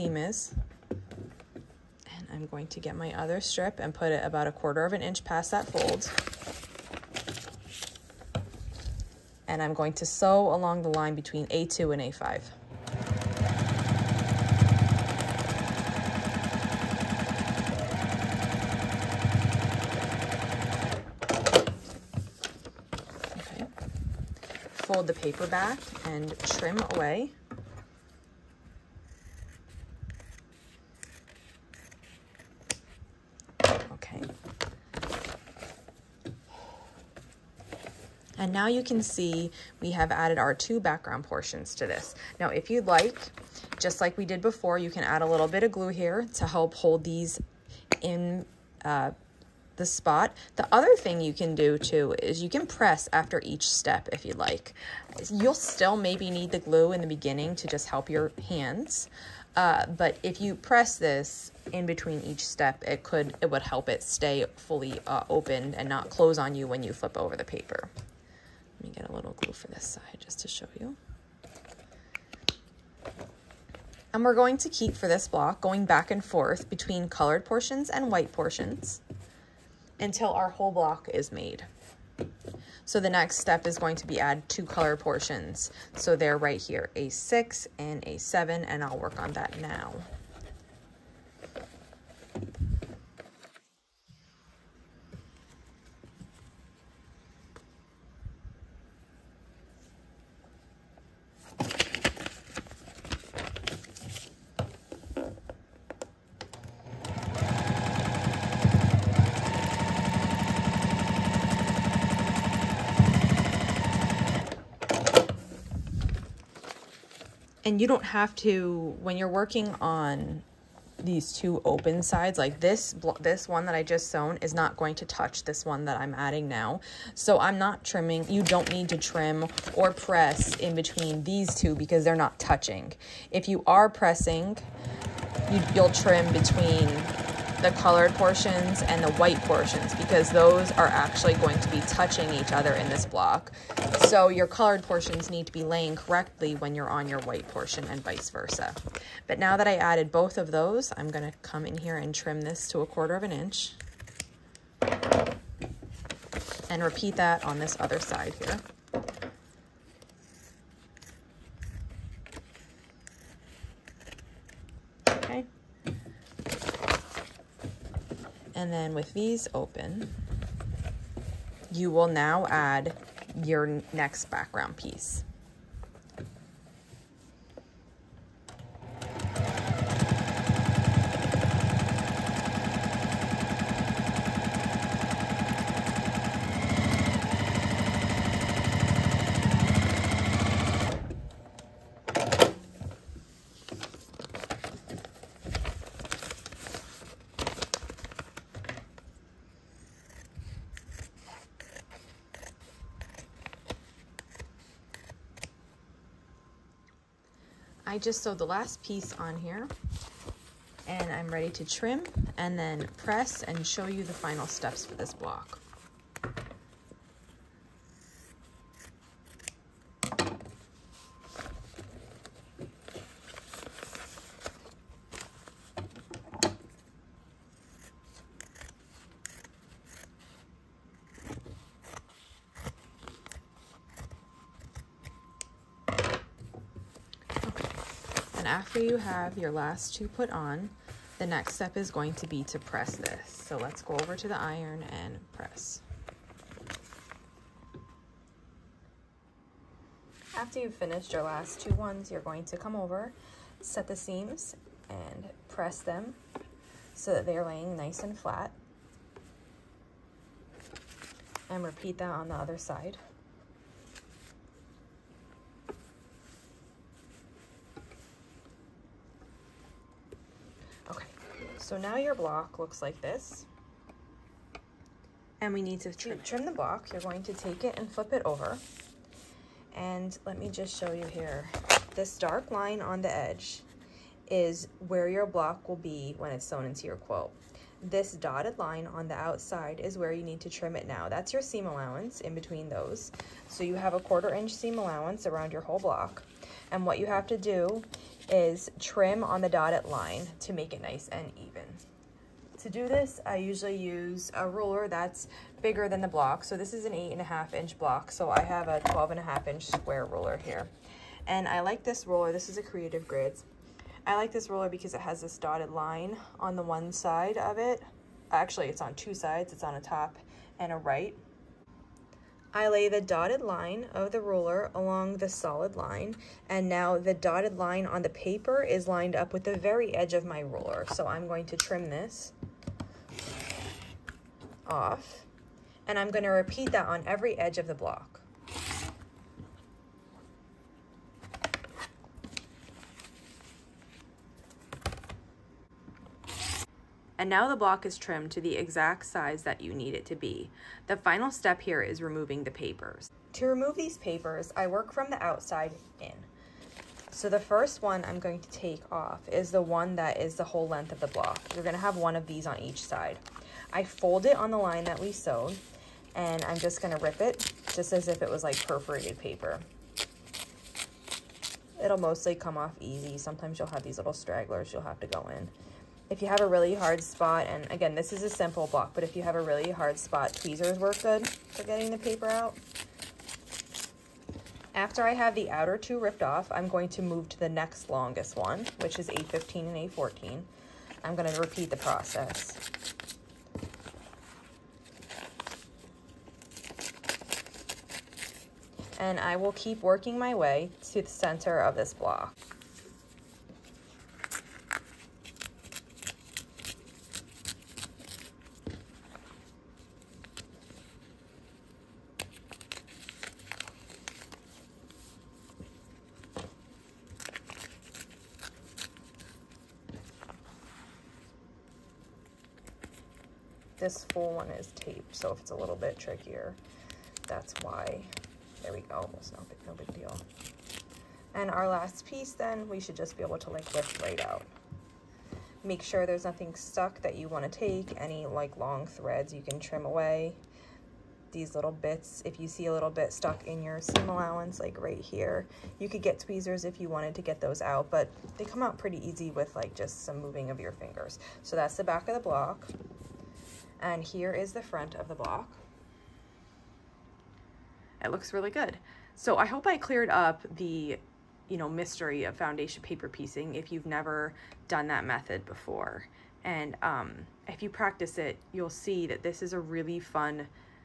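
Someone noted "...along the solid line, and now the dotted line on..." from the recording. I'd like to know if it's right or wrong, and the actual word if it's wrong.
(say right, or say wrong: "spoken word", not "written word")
right.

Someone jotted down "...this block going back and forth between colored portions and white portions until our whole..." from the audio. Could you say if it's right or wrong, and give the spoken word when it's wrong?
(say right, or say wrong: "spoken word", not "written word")
right.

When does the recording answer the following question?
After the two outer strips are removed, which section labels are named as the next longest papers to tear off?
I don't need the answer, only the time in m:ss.
6:29.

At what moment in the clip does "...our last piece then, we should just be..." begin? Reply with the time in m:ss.
7:11.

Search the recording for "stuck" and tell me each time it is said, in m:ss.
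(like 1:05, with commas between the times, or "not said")
7:16, 7:23.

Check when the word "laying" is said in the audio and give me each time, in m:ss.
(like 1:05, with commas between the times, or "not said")
2:25, 4:17.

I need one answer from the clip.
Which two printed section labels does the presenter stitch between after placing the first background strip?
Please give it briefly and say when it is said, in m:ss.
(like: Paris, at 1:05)
A2 and A5, at 0:11.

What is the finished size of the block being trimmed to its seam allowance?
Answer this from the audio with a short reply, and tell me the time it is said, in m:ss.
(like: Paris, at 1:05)
8 1/2 inch, at 5:06.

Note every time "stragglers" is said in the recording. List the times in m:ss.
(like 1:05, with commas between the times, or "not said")
6:14.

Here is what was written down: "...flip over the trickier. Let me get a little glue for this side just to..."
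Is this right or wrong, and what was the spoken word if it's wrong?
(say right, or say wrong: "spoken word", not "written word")
wrong: "paper", not "trickier".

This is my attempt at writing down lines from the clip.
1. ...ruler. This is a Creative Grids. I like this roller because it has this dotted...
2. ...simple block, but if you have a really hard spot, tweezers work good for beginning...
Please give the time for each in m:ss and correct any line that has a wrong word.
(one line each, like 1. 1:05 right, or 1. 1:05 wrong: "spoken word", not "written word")
1. 5:12 right
2. 6:18 wrong: "getting", not "beginning".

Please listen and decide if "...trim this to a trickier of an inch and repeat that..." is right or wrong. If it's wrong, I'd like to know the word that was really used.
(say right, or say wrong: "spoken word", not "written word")
wrong: "quarter", not "trickier".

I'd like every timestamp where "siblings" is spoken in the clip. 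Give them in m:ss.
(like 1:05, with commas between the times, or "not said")
not said.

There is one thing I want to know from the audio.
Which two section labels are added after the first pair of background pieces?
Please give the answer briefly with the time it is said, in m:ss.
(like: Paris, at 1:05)
A6 and A7, at 1:26.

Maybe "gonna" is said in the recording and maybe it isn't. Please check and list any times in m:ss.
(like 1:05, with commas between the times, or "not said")
2:31, 5:36, 6:01, 6:06, 6:31.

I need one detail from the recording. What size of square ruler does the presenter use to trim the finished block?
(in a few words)
12 1/2 inch.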